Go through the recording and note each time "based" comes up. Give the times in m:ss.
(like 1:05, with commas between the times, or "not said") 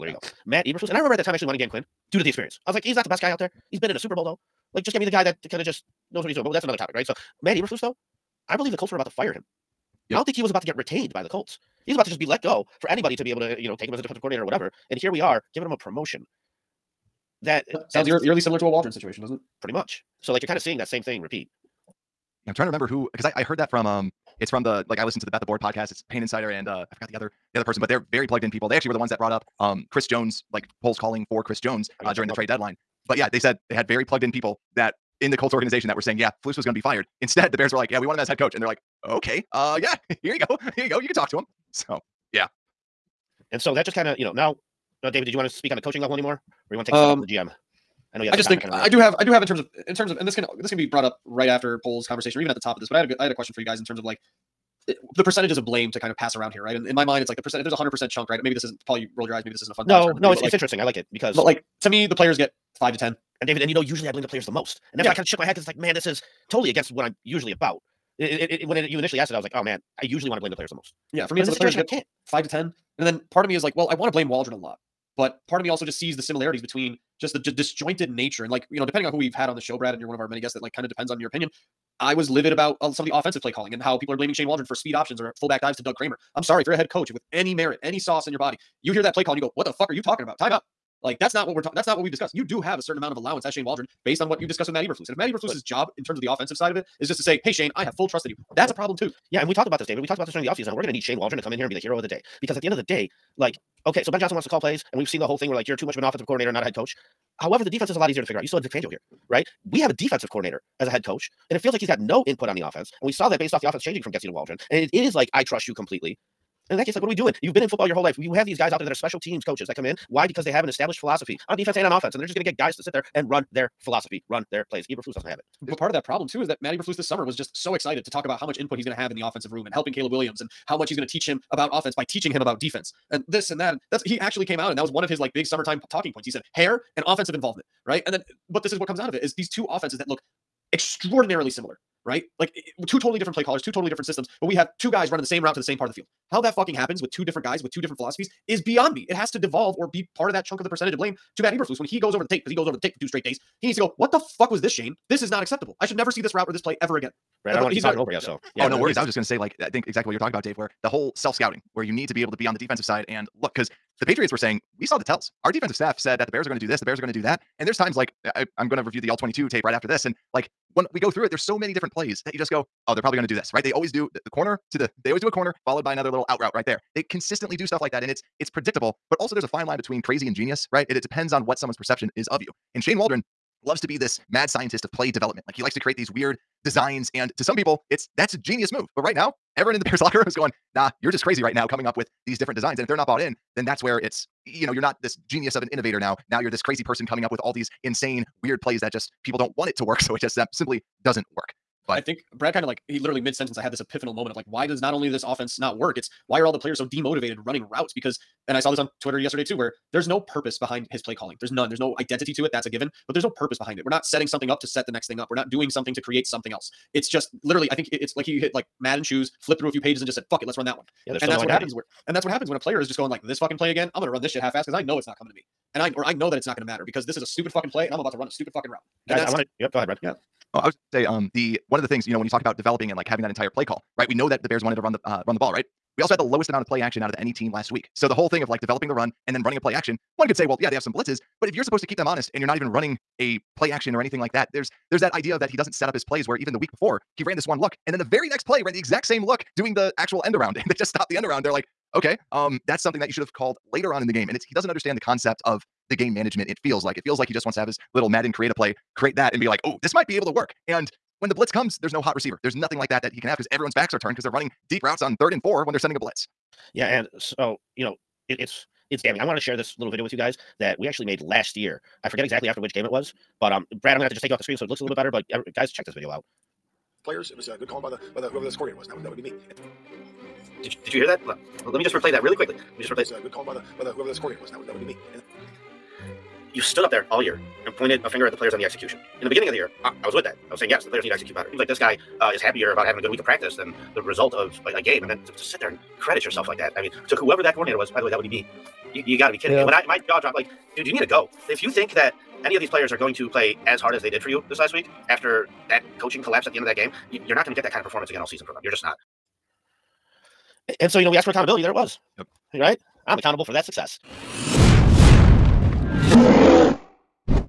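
1:34, 1:53.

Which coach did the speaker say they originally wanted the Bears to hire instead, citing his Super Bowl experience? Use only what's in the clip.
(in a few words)
Dan Quinn.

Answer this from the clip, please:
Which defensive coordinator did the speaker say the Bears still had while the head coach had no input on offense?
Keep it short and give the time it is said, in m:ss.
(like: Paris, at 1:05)
Vic Fangio, at 1:48.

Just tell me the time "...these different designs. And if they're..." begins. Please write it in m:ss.
3:12.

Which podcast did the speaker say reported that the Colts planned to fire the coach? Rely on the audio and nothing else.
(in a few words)
Bet the Board.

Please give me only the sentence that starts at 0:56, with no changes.
And in my mind, it's like the percent.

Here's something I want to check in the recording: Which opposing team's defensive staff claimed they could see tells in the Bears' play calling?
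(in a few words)
Patriots.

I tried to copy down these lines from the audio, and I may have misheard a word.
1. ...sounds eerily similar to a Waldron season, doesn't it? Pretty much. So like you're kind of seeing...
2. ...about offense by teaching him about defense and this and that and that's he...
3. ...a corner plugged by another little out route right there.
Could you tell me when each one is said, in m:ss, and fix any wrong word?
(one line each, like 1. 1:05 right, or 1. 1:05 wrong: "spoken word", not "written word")
1. 0:17 wrong: "situation", not "season"
2. 2:11 right
3. 2:55 wrong: "followed", not "plugged".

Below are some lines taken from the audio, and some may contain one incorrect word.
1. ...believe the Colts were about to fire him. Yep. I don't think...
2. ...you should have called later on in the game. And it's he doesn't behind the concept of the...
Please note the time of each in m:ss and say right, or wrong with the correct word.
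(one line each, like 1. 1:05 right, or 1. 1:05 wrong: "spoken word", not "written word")
1. 0:08 right
2. 4:13 wrong: "understand", not "behind".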